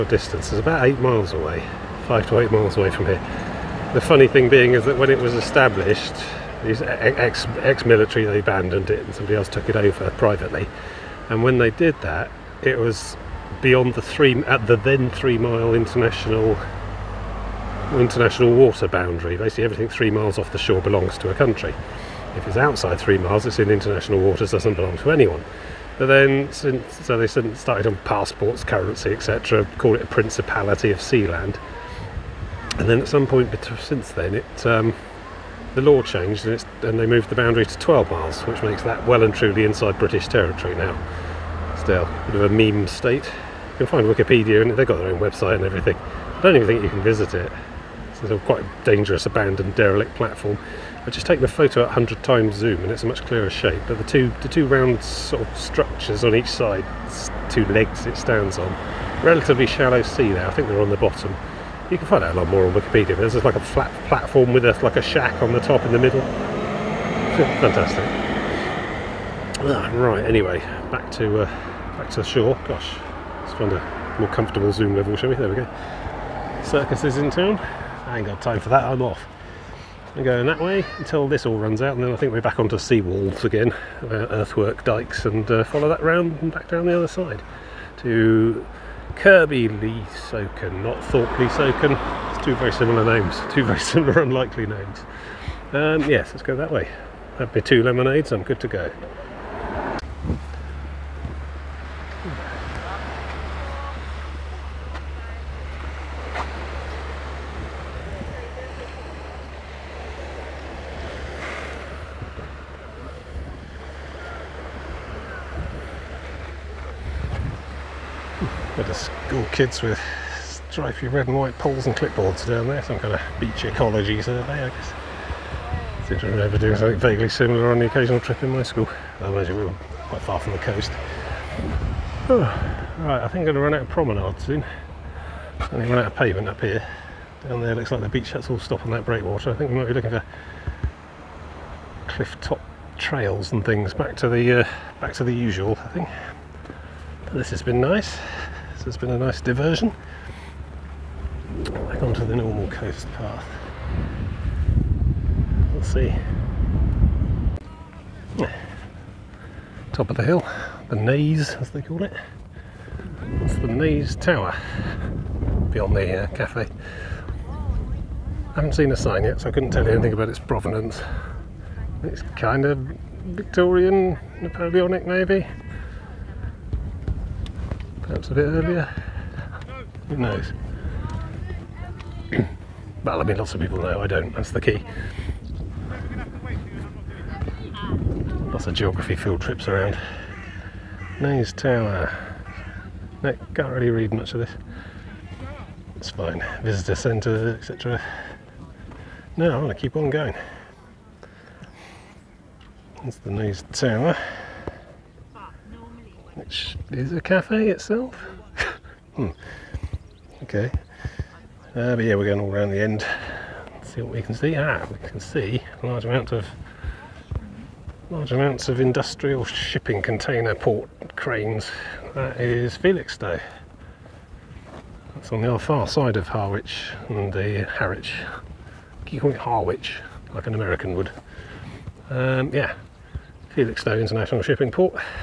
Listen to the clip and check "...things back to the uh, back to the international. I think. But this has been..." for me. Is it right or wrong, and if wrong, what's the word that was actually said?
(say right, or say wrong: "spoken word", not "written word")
wrong: "usual", not "international".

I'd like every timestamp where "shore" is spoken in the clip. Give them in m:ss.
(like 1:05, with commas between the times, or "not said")
0:20, 1:12.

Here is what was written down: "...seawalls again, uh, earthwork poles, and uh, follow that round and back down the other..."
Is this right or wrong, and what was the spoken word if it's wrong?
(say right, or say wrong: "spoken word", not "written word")
wrong: "dikes", not "poles".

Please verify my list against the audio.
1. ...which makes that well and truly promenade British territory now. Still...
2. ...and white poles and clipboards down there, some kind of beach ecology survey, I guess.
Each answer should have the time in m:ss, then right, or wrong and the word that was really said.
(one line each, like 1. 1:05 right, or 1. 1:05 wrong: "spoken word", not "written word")
1. 0:38 wrong: "inside", not "promenade"
2. 2:01 right.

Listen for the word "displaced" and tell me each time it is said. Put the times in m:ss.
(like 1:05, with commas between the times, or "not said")
not said.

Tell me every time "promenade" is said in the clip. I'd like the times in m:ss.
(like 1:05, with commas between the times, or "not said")
2:13.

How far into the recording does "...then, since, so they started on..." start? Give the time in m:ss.
0:26.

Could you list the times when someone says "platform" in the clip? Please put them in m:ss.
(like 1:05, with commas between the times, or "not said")
0:50, 1:04.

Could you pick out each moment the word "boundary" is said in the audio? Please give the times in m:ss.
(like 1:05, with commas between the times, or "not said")
0:18, 0:37.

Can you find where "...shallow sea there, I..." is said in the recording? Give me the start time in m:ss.
0:59.